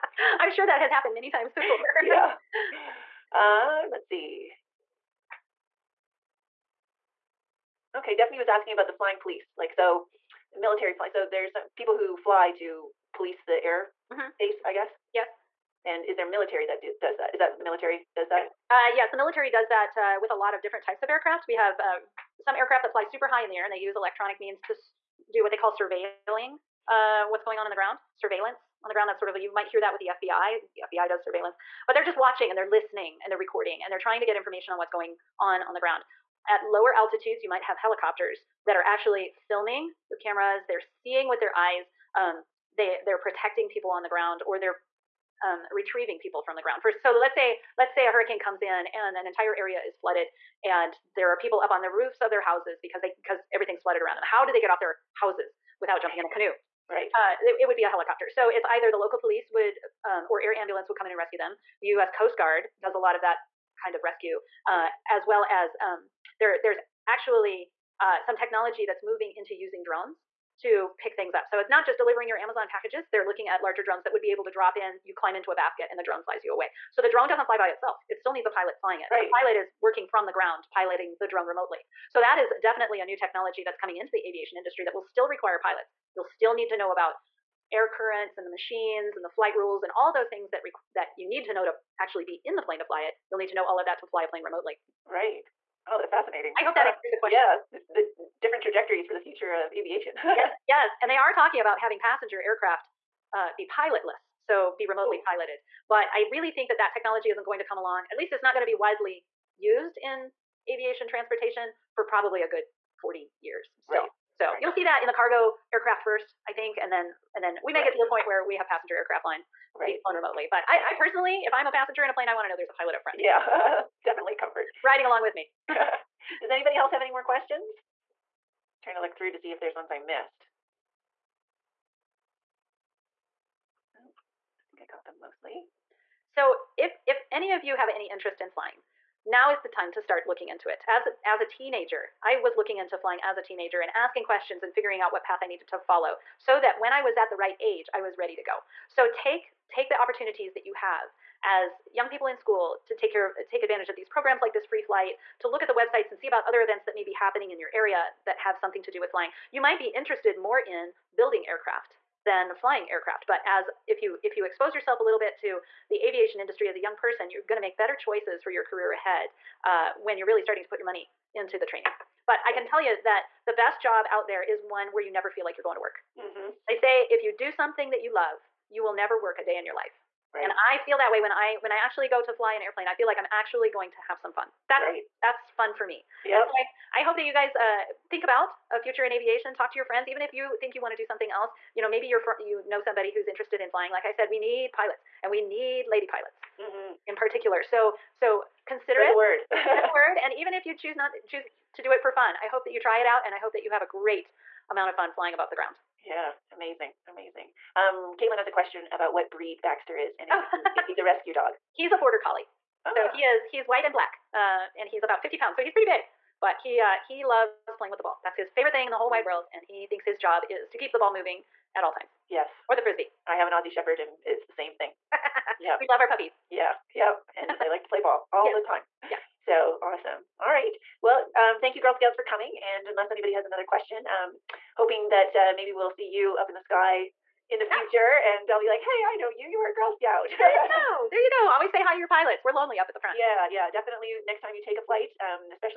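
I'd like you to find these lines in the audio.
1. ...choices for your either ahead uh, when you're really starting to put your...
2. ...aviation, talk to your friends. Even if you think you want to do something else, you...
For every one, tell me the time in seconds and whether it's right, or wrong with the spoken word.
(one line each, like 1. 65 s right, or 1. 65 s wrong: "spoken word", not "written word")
1. 167 s wrong: "career", not "either"
2. 189 s right.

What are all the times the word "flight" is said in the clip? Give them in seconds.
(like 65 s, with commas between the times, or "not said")
89 s, 154 s, 244 s.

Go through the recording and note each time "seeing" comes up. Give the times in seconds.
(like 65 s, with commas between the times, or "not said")
40 s.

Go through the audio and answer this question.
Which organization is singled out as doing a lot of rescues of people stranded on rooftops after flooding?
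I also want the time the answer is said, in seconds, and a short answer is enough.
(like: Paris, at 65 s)
US Coast Guard, at 61 s.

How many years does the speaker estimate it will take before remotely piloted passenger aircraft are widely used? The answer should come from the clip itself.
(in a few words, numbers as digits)
40.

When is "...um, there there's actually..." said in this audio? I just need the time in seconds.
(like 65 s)
65 s.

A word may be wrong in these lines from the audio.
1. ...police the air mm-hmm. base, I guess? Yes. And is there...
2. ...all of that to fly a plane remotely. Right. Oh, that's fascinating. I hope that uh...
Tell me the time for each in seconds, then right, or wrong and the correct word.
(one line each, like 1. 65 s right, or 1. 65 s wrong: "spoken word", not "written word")
1. 13 s right
2. 93 s right.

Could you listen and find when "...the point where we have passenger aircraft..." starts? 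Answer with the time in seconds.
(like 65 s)
117 s.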